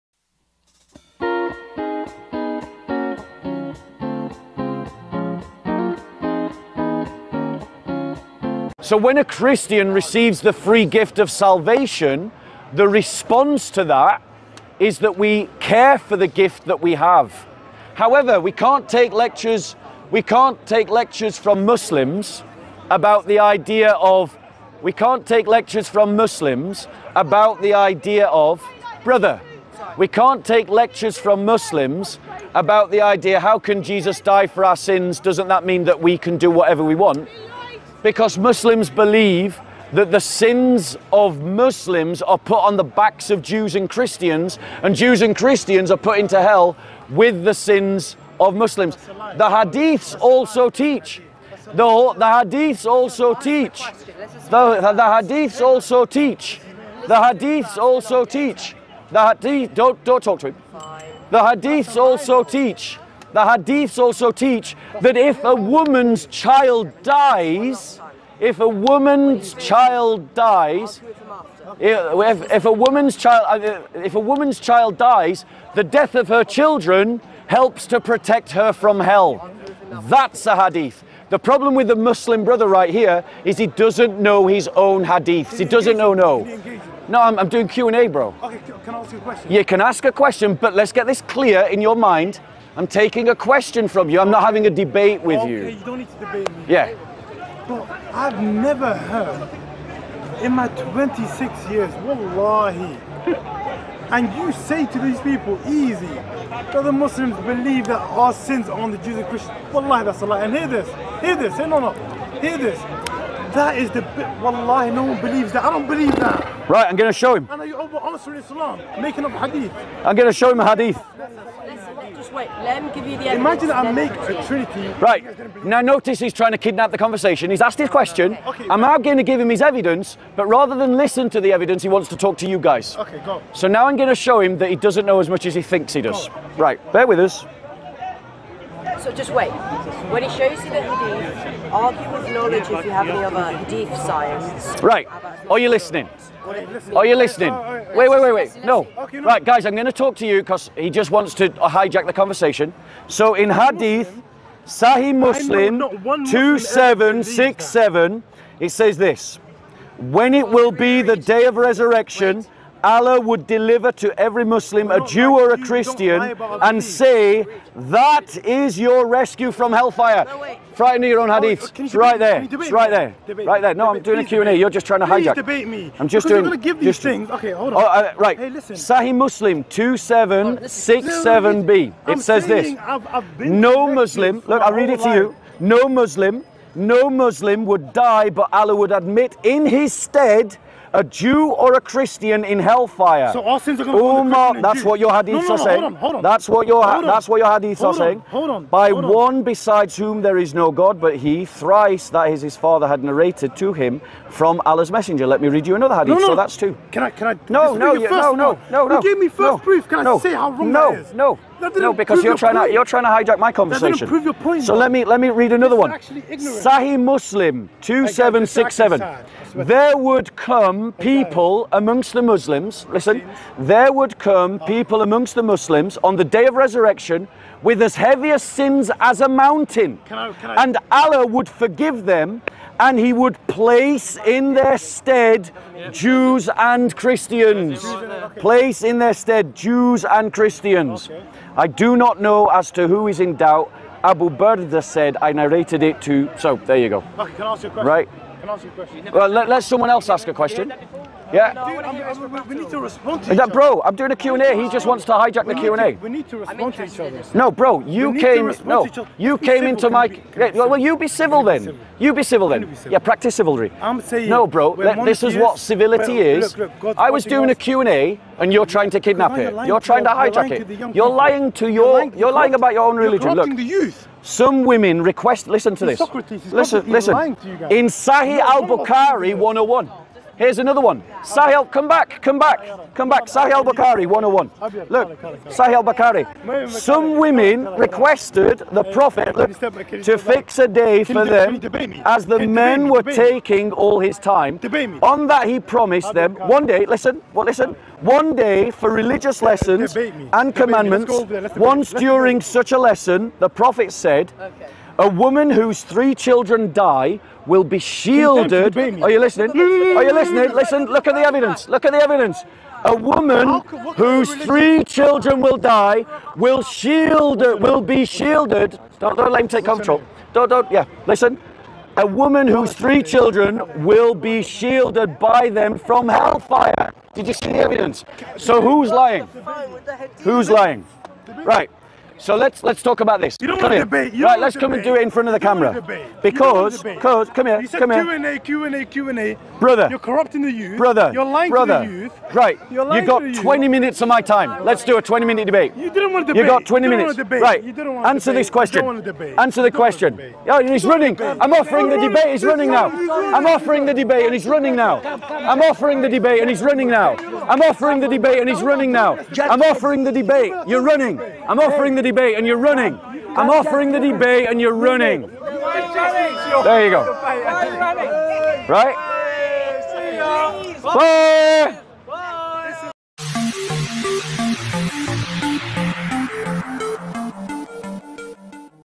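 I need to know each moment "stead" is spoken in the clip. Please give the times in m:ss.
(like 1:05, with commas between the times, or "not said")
3:09, 3:54, 3:59.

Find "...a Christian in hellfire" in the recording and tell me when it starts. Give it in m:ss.
3:11.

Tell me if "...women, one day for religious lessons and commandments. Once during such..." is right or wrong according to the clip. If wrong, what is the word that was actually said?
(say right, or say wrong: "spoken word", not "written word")
wrong: "listen", not "women".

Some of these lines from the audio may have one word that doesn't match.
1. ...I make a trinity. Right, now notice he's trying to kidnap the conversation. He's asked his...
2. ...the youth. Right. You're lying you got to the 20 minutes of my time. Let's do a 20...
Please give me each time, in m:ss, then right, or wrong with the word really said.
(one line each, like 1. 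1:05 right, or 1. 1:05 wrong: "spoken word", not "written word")
1. 2:03 right
2. 5:41 right.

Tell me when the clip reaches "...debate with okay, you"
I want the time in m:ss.
1:34.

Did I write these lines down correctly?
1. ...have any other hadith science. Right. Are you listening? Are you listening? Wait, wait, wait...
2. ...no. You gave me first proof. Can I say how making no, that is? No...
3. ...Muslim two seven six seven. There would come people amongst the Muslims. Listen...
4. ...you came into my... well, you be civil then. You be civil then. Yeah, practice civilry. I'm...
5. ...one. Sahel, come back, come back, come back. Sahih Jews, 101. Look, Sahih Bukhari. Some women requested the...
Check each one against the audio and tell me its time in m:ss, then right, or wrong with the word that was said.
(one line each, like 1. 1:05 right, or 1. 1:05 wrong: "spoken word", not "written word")
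1. 2:22 right
2. 3:28 wrong: "wrong", not "making"
3. 3:36 right
4. 4:19 right
5. 4:40 wrong: "Bukhari", not "Jews".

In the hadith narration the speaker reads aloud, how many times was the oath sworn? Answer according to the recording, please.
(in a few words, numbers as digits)
thrice.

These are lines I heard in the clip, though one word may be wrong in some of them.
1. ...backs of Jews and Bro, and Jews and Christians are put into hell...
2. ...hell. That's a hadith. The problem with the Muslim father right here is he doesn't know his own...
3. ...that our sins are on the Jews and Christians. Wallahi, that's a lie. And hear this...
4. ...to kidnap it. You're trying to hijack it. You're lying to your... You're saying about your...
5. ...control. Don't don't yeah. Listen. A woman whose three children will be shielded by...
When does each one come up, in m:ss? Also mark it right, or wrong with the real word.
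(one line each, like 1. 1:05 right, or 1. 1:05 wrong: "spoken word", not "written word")
1. 0:42 wrong: "Christians", not "Bro"
2. 1:18 wrong: "brother", not "father"
3. 1:47 right
4. 4:28 wrong: "lying", not "saying"
5. 5:19 right.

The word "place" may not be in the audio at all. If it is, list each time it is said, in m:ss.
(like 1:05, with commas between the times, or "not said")
3:53, 3:58.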